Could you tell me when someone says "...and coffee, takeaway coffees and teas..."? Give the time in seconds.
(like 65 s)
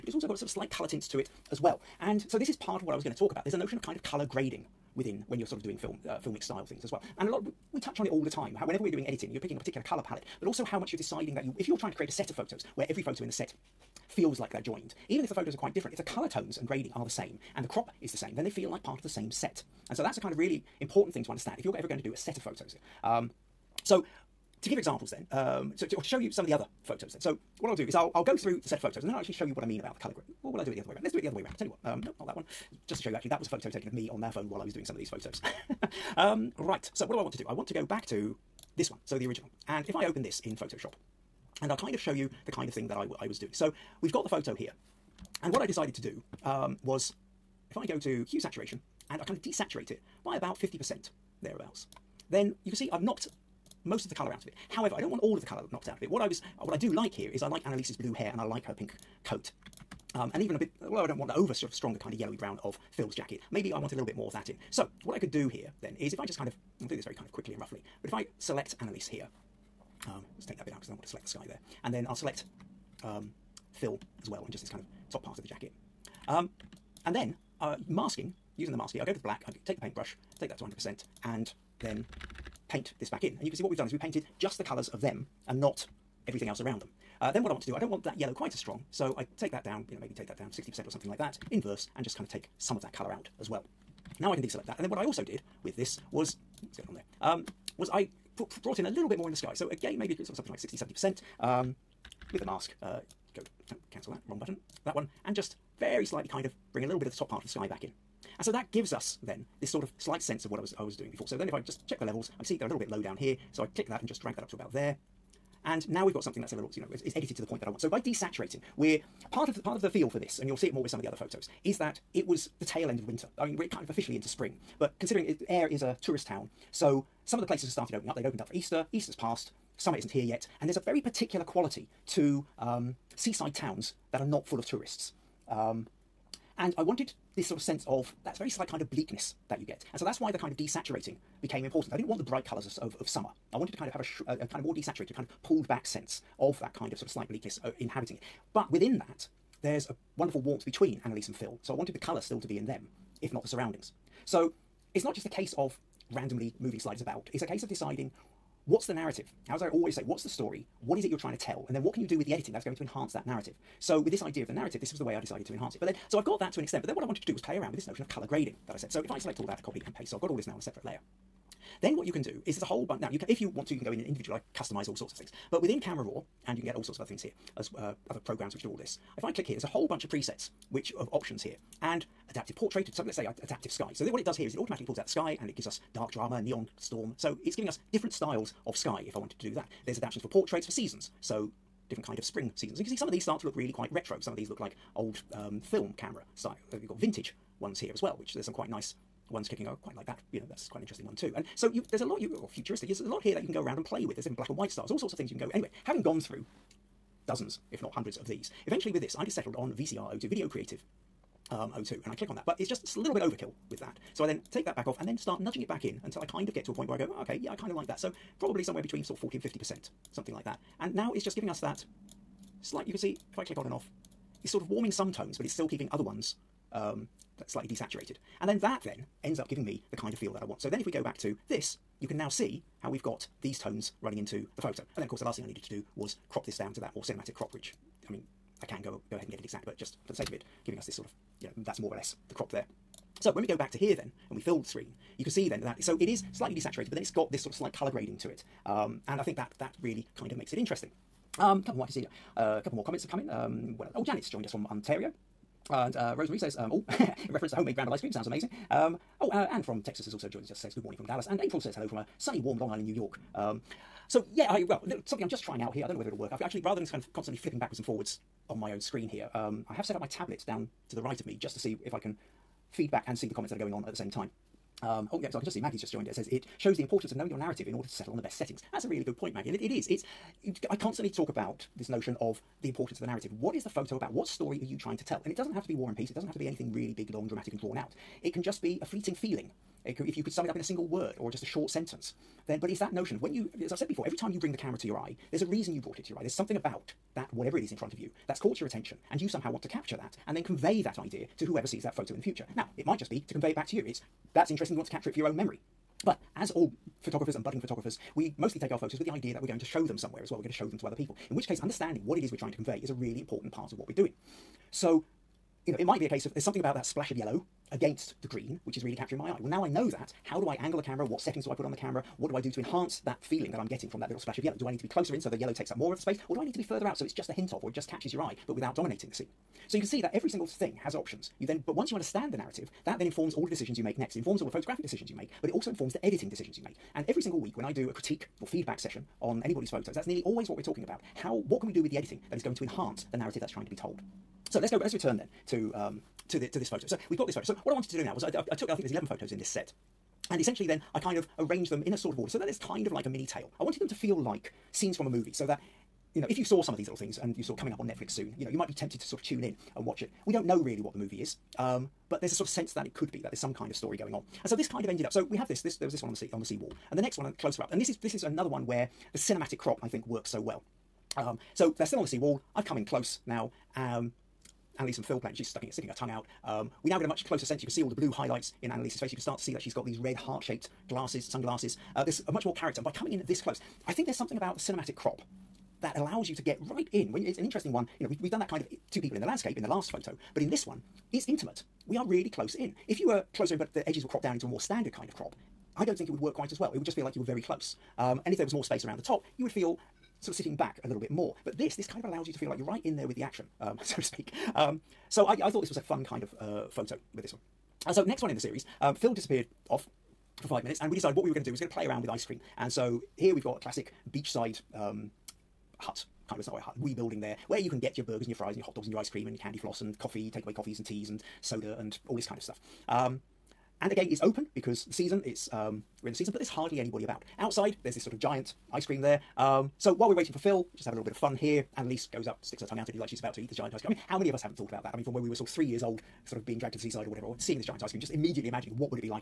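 419 s.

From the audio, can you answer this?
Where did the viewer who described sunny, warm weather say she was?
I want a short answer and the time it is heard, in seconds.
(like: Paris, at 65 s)
Long Island, New York, at 262 s.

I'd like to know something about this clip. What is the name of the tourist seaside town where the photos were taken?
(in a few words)
Ayr.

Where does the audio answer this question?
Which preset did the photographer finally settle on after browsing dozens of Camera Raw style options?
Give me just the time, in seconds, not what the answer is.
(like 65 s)
209 s.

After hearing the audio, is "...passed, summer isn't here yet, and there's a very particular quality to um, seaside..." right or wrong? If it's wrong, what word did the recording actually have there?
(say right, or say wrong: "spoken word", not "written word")
right.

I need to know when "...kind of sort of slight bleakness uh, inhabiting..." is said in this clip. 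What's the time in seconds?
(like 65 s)
146 s.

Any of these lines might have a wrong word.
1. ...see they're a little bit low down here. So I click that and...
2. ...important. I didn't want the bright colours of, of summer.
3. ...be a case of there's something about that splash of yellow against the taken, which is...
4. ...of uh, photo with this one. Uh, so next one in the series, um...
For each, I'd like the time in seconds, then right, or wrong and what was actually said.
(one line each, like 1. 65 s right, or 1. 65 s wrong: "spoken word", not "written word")
1. 112 s right
2. 141 s right
3. 315 s wrong: "green", not "taken"
4. 406 s right.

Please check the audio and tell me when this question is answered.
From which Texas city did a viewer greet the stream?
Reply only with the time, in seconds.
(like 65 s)
261 s.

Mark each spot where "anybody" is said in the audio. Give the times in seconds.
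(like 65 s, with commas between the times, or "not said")
339 s, 426 s.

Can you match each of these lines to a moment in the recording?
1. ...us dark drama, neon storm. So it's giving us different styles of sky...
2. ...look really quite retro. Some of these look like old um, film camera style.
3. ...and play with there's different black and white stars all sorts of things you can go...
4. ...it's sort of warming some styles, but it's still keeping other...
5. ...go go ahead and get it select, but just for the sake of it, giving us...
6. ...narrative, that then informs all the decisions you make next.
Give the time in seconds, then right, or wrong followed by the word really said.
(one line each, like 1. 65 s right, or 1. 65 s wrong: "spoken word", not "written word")
1. 185 s right
2. 193 s right
3. 203 s right
4. 224 s wrong: "tones", not "styles"
5. 238 s wrong: "exact", not "select"
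6. 332 s right.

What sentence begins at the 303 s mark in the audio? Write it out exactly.
It's that's interesting, you want to capture it for your own memory.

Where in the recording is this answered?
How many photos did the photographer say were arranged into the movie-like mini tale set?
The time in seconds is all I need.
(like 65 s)
348 s.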